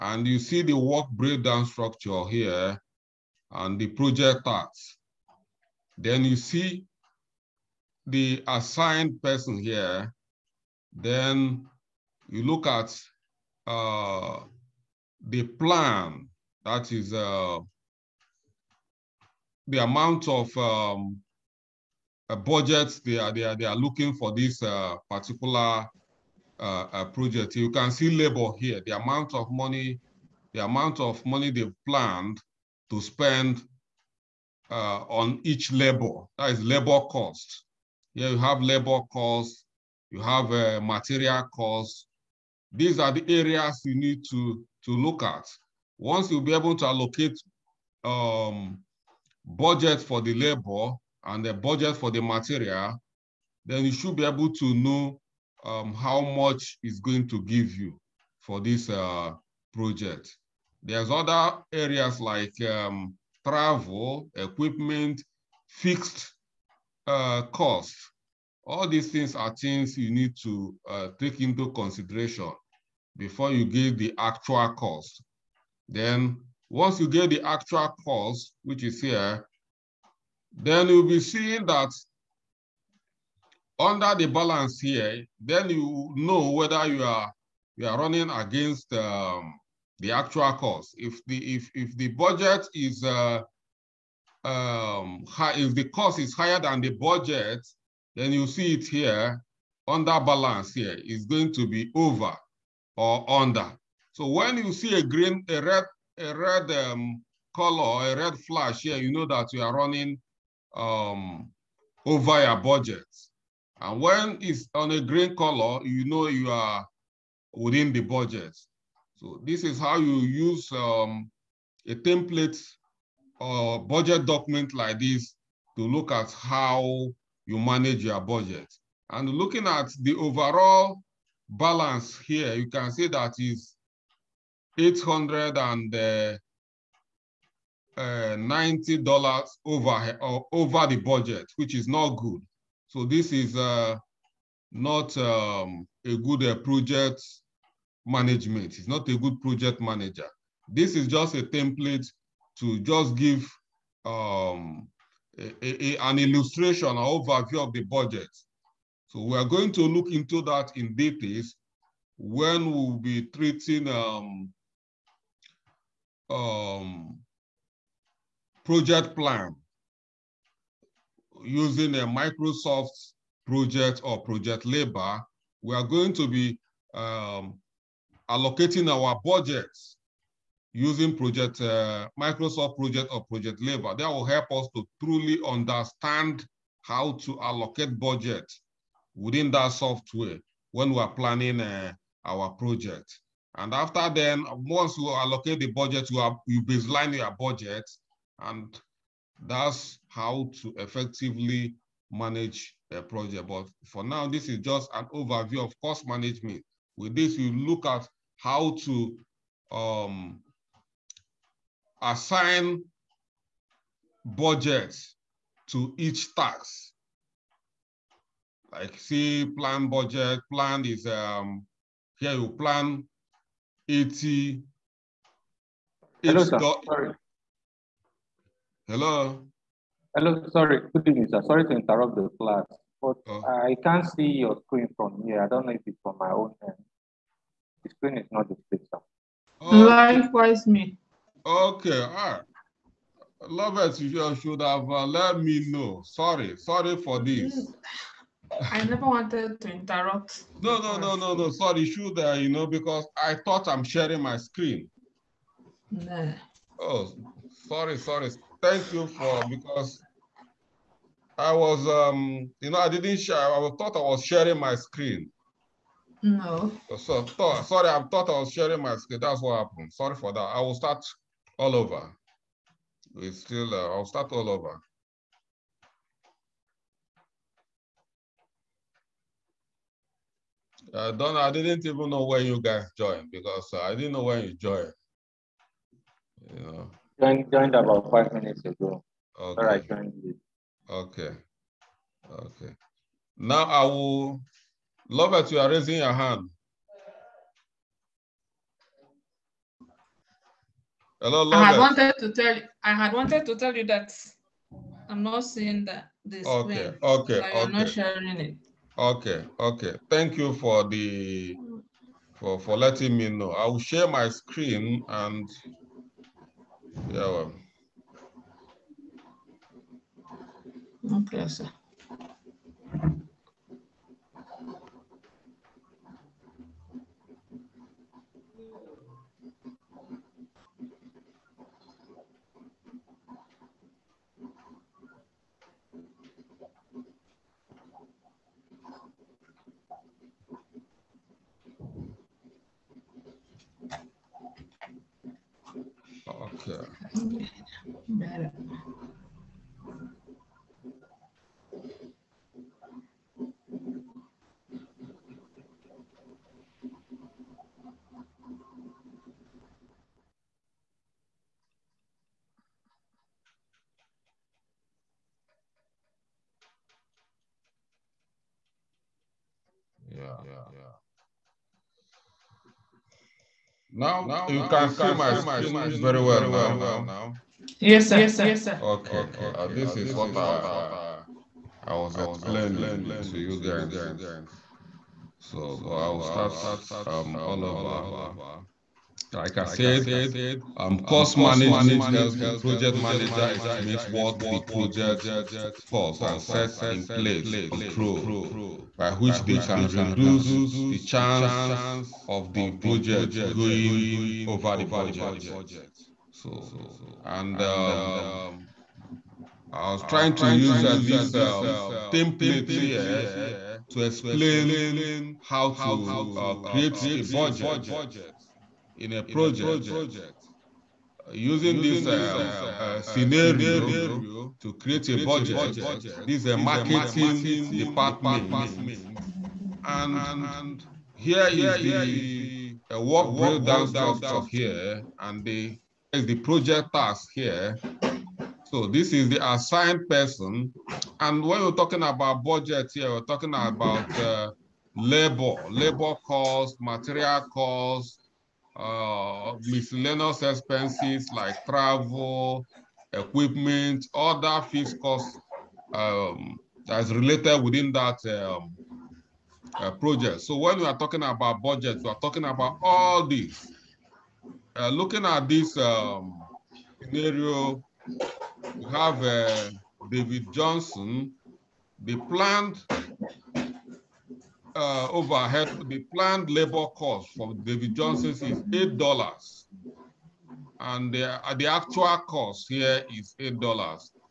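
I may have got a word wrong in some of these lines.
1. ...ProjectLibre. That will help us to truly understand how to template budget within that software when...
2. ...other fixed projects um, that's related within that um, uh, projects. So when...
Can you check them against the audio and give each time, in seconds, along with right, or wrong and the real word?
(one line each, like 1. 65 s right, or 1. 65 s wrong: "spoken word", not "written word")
1. 183 s wrong: "allocate", not "template"
2. 454 s wrong: "costs", not "projects".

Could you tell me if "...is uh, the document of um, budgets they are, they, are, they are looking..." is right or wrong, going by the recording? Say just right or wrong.
wrong.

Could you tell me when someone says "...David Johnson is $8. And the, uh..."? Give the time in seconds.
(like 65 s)
477 s.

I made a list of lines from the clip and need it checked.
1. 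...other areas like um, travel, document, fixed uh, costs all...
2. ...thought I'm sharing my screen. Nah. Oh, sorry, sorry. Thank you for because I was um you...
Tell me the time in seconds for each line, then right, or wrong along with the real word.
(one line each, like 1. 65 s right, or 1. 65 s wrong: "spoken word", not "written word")
1. 61 s wrong: "equipment", not "document"
2. 253 s right.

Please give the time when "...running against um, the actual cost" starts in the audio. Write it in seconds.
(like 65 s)
87 s.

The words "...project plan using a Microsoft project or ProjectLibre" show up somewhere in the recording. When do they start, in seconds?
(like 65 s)
168 s.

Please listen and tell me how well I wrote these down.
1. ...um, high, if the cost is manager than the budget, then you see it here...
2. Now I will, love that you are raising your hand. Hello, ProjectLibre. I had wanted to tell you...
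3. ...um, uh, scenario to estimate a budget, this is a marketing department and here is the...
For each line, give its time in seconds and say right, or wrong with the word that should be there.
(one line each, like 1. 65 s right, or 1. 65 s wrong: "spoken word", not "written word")
1. 94 s wrong: "higher", not "manager"
2. 293 s wrong: "Love", not "ProjectLibre"
3. 422 s wrong: "create", not "estimate".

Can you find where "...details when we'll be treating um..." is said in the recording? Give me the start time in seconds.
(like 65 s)
160 s.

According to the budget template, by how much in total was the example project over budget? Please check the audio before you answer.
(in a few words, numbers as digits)
$890.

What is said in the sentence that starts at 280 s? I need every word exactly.
Uh, Donna, I didn't even know when you guys joined because uh, I didn't know when you joined.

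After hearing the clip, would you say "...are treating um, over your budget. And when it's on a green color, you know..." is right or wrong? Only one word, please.
wrong.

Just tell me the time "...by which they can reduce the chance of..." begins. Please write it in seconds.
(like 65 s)
398 s.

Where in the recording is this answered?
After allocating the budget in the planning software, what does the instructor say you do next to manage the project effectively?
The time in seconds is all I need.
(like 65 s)
196 s.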